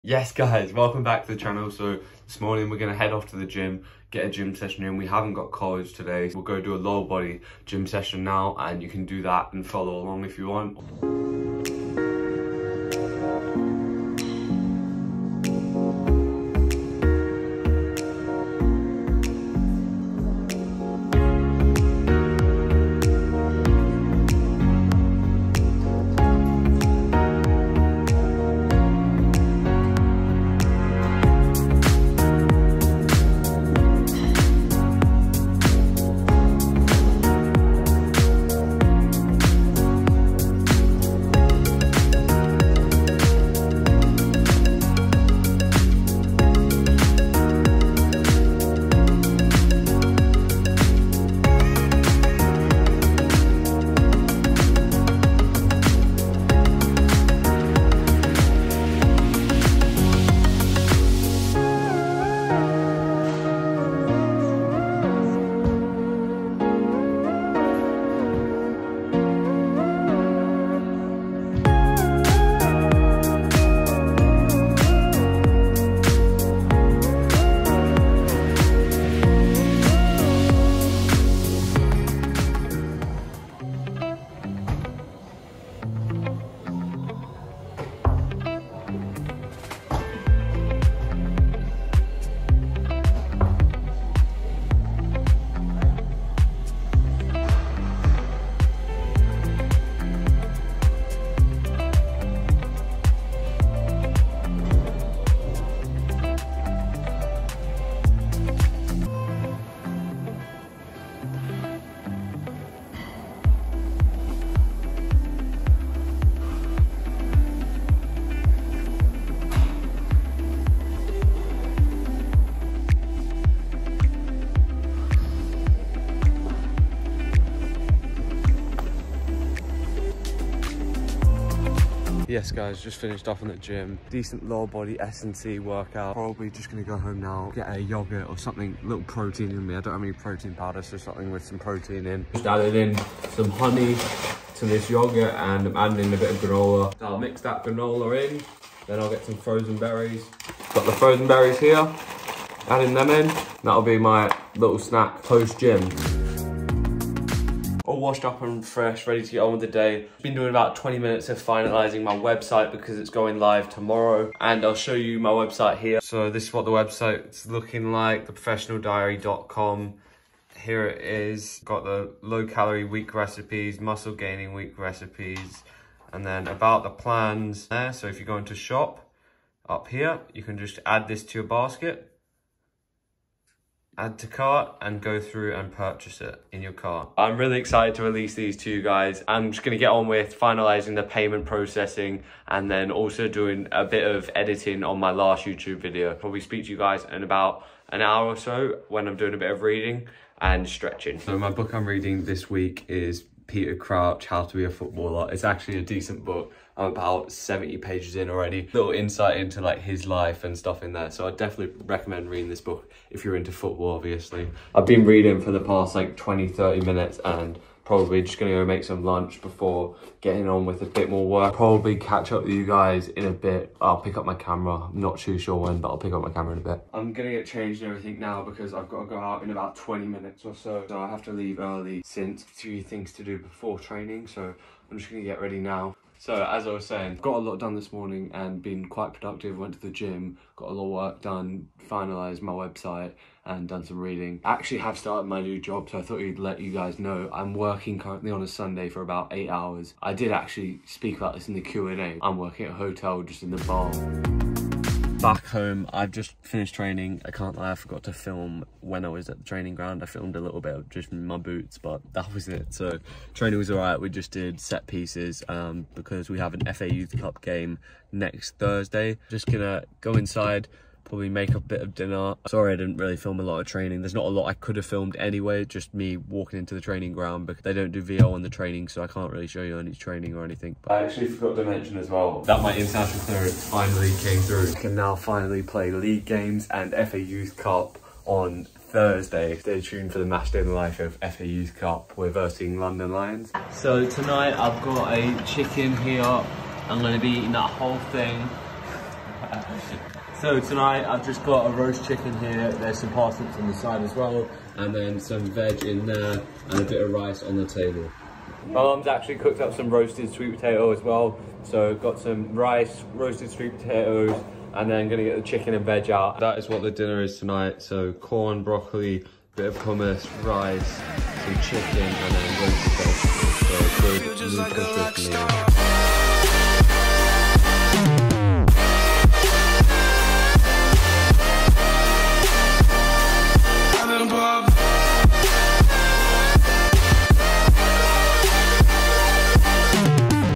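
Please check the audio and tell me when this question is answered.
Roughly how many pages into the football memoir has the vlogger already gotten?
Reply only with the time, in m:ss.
3:27.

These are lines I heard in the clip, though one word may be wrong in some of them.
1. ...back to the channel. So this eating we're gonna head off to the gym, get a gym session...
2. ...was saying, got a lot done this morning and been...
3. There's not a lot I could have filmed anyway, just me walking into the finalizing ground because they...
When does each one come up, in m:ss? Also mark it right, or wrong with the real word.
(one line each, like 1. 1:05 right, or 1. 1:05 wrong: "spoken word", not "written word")
1. 0:01 wrong: "morning", not "eating"
2. 3:56 right
3. 4:34 wrong: "training", not "finalizing".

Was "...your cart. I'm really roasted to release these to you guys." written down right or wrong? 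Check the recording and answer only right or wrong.
wrong.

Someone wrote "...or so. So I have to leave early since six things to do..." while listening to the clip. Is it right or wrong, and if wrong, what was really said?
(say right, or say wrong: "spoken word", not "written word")
wrong: "three", not "six".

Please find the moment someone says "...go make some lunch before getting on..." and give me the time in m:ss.
3:38.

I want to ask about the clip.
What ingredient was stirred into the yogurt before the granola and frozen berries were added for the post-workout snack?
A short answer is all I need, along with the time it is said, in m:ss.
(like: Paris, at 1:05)
honey, at 2:23.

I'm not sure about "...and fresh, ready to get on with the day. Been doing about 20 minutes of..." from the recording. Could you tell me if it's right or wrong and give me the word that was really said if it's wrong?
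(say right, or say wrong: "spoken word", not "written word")
right.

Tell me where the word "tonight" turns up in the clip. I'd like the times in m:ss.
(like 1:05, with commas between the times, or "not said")
4:54, 5:00, 5:17.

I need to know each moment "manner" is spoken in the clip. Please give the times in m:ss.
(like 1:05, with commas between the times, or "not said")
not said.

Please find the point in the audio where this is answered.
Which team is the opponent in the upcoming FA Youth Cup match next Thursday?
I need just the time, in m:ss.
4:52.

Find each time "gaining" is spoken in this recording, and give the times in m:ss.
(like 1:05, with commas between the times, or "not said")
2:54.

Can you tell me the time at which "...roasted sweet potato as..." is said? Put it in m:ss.
5:09.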